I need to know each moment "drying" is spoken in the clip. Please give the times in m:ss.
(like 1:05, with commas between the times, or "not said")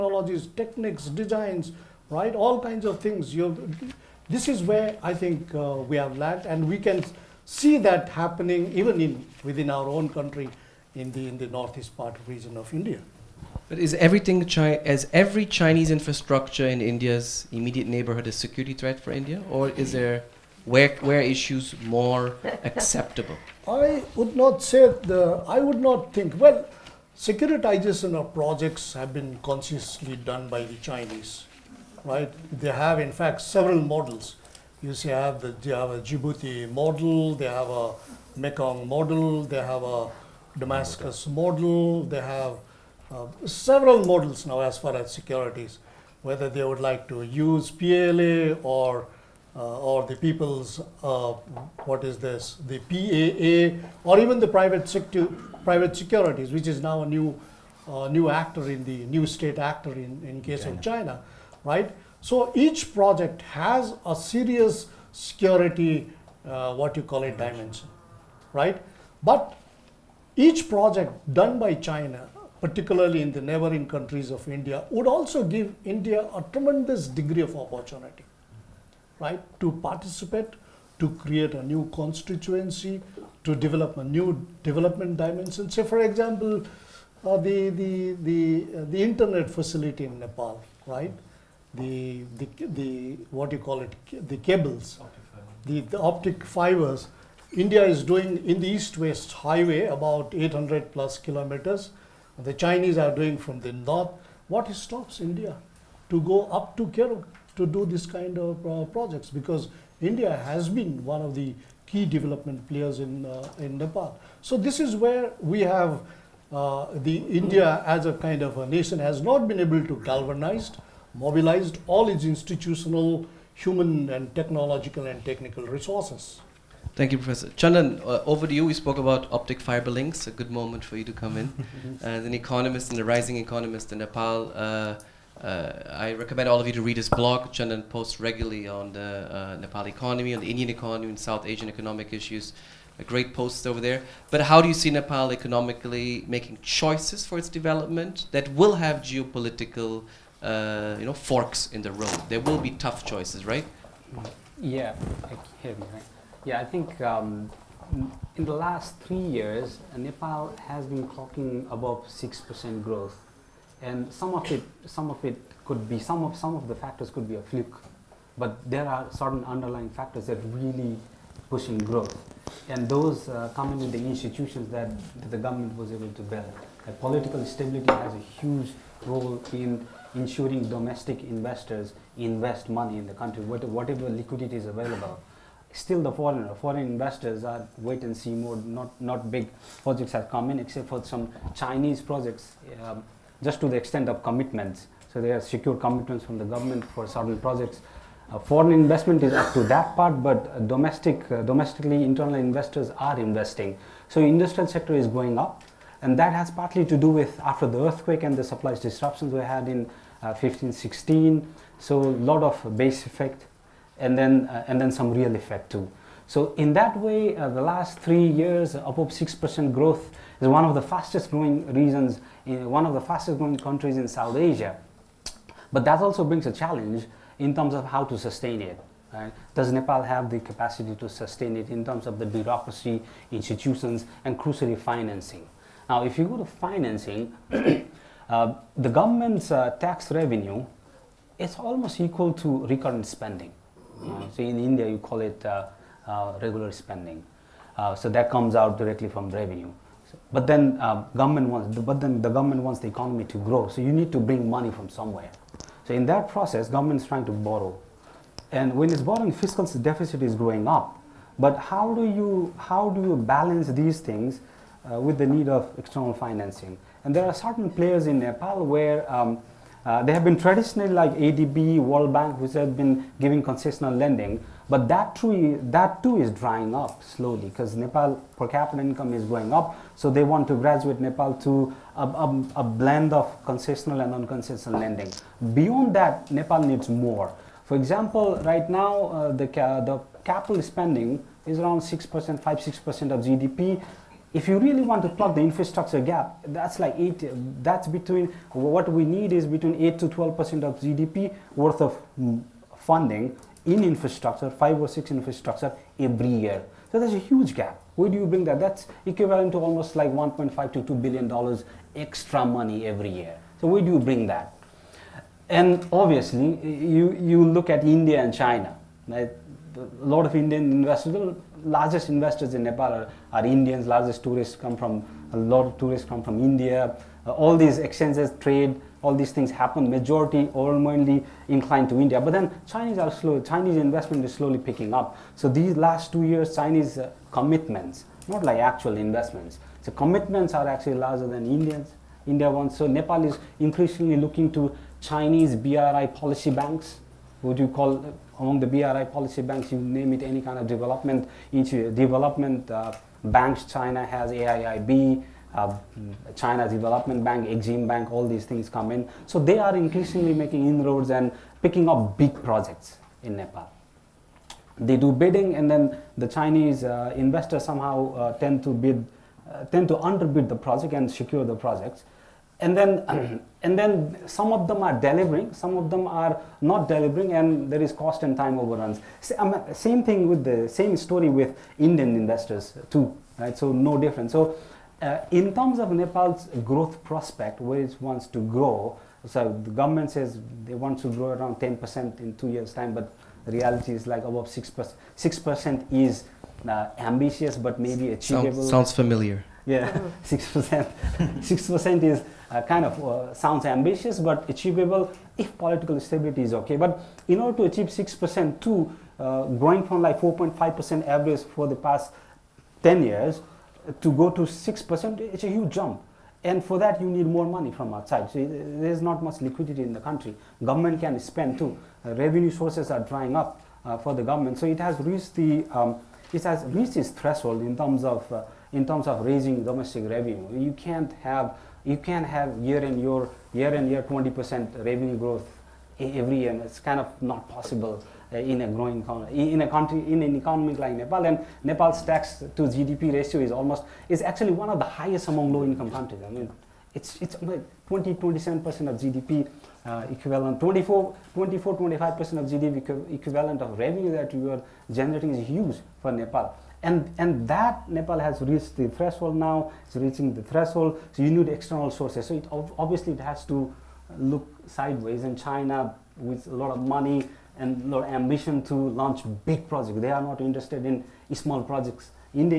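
4:36, 7:02.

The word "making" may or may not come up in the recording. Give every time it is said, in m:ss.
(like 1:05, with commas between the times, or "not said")
2:26, 6:00.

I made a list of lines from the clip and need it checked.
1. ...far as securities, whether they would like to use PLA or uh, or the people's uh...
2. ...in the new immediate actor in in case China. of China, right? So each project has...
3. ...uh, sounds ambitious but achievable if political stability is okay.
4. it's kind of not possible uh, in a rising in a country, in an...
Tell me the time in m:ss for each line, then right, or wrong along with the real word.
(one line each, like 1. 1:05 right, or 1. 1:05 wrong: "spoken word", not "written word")
1. 0:44 right
2. 0:58 wrong: "state", not "immediate"
3. 6:43 right
4. 7:16 wrong: "growing", not "rising".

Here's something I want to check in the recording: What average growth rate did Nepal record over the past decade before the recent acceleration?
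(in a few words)
4.5%.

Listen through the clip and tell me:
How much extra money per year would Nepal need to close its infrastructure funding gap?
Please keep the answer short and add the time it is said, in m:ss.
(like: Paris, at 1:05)
1.5 to 2 billion dollars, at 5:10.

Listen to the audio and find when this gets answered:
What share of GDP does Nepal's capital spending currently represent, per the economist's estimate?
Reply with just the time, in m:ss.
4:52.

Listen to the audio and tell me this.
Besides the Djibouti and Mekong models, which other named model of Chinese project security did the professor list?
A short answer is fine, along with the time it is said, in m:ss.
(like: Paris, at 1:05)
Damascus model, at 0:40.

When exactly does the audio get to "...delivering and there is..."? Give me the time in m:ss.
6:16.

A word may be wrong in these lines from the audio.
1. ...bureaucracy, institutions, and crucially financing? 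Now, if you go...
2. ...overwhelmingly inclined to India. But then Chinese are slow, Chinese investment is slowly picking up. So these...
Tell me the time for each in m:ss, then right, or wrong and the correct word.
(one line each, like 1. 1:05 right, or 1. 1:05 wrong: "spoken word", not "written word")
1. 3:52 right
2. 5:30 right.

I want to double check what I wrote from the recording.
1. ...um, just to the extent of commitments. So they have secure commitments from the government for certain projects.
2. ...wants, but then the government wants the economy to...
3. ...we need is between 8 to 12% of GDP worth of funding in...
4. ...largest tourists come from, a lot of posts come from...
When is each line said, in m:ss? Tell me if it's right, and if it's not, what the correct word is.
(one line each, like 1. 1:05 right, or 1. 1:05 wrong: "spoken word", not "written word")
1. 3:12 right
2. 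4:11 right
3. 4:58 right
4. 5:23 wrong: "tourists", not "posts".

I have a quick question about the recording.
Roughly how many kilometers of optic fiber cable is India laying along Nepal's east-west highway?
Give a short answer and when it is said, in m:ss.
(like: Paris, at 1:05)
800 plus kilometers, at 1:40.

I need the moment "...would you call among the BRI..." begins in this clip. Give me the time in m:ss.
5:47.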